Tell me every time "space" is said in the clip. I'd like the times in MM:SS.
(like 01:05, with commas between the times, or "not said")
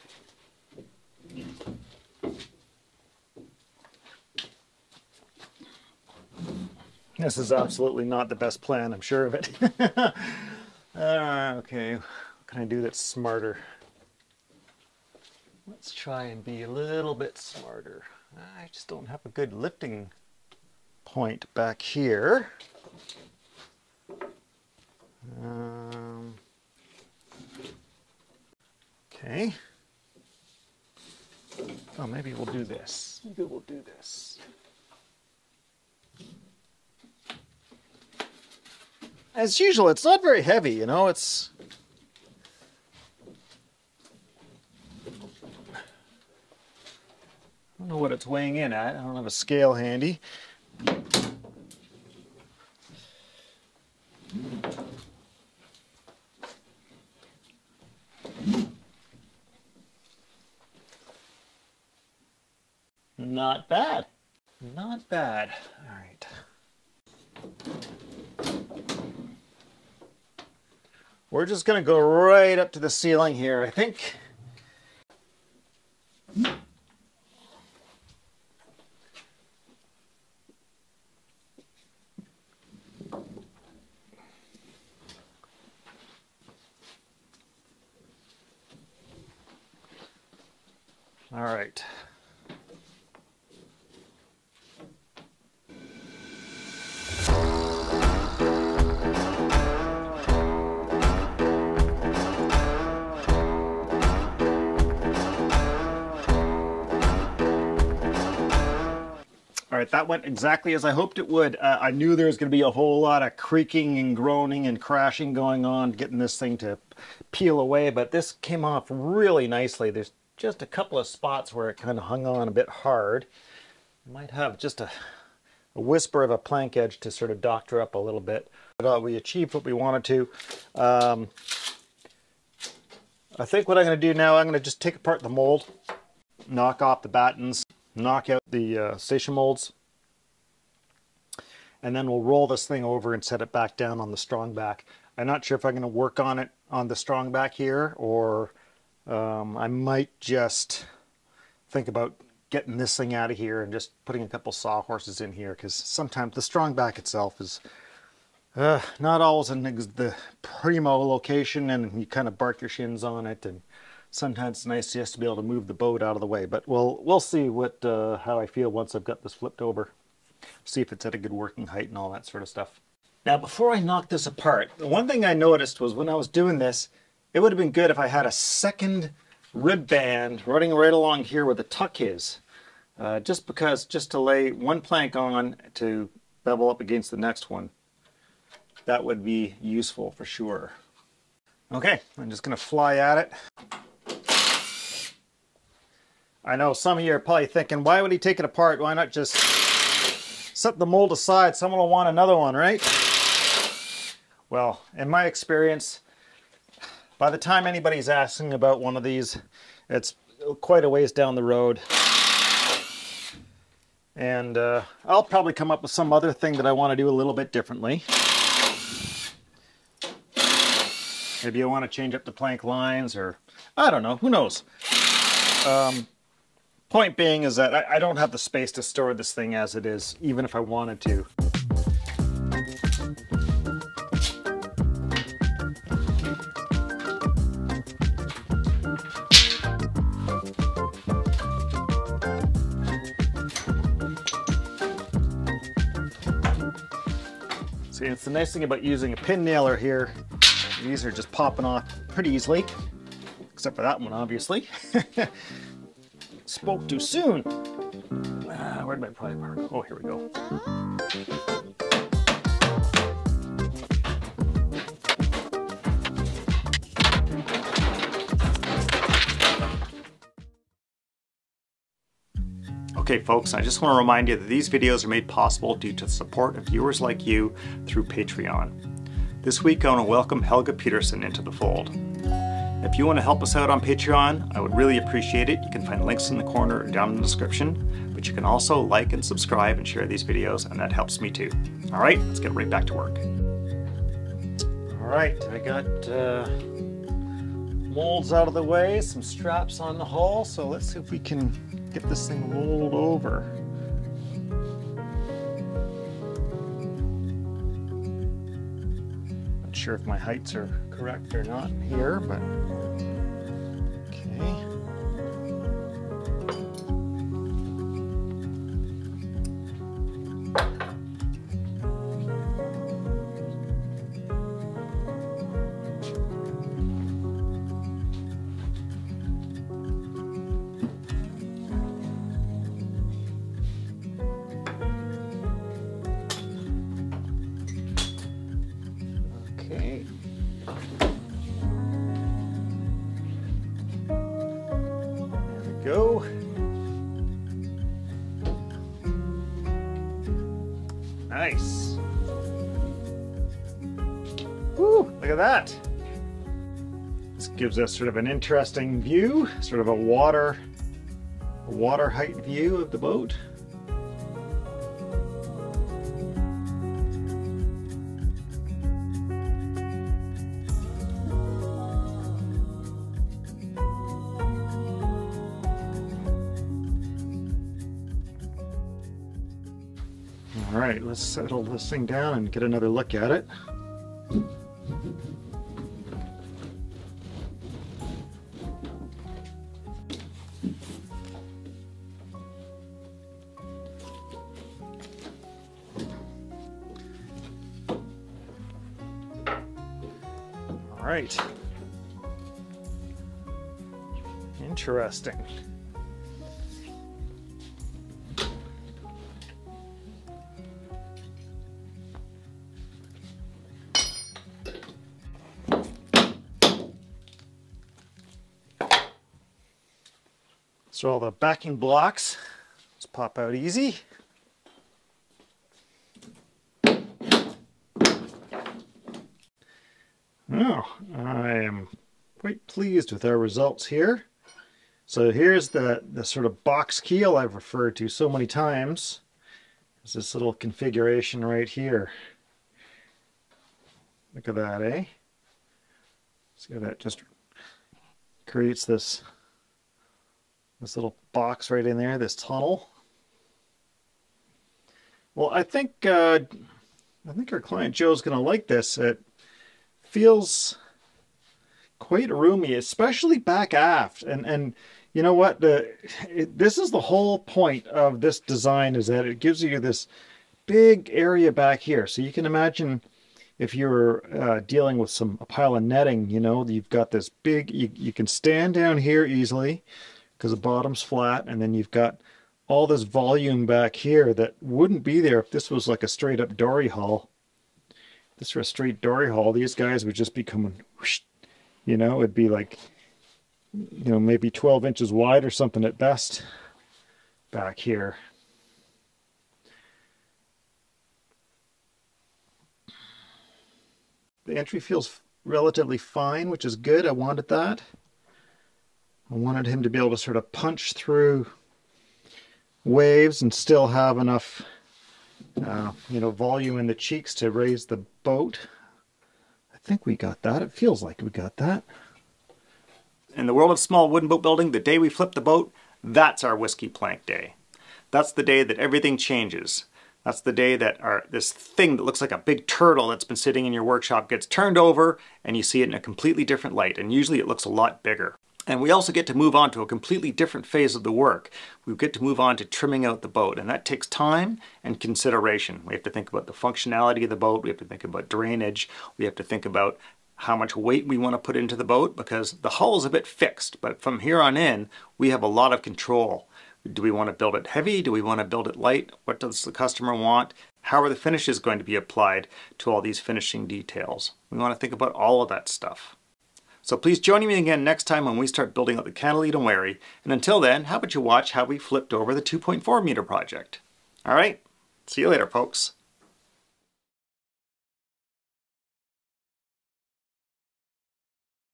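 03:48.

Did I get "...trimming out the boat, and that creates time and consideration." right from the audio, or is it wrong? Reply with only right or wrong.
wrong.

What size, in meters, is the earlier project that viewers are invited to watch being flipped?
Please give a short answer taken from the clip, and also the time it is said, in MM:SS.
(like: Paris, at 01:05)
2.4 meters, at 09:32.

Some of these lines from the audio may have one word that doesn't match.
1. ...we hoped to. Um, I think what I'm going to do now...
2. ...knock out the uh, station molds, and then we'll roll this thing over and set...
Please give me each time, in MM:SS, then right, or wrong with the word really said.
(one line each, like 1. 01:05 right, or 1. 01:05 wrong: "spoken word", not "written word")
1. 02:09 wrong: "wanted", not "hoped"
2. 02:17 right.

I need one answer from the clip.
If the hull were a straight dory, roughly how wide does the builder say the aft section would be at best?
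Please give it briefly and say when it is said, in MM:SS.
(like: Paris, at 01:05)
12 inches, at 08:14.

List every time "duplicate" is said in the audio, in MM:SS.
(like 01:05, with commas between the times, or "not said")
not said.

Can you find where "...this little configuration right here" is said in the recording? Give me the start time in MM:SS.
07:20.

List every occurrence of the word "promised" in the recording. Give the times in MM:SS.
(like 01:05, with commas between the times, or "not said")
not said.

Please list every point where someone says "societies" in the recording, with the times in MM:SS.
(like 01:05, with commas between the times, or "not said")
not said.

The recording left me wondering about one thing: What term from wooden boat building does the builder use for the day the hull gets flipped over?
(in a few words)
whiskey plank day.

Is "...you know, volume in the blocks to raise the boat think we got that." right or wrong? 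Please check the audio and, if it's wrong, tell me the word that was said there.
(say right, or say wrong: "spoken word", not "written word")
wrong: "cheeks", not "blocks".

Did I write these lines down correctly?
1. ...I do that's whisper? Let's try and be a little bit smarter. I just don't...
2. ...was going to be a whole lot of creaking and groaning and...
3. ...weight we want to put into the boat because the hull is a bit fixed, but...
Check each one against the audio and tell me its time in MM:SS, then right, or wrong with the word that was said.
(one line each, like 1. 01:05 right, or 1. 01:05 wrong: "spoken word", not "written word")
1. 00:12 wrong: "smarter", not "whisper"
2. 01:52 right
3. 09:10 right.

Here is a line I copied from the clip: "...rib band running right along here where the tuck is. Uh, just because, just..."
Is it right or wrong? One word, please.
right.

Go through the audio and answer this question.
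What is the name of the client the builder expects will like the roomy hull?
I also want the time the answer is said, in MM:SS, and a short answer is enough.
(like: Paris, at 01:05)
Joe, at 07:37.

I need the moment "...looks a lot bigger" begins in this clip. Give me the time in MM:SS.
08:57.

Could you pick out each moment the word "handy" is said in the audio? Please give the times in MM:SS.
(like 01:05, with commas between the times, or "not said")
00:49.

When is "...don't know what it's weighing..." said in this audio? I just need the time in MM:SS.
00:47.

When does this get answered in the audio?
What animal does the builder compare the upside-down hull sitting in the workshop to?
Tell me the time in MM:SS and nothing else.
08:52.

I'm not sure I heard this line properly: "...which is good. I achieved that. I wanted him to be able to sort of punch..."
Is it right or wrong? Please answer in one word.
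wrong.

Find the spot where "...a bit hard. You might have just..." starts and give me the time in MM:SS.
02:02.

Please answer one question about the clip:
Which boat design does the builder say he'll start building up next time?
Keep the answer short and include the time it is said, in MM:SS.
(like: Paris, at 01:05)
Catalina Wherry, at 09:29.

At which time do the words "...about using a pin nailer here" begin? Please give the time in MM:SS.
04:08.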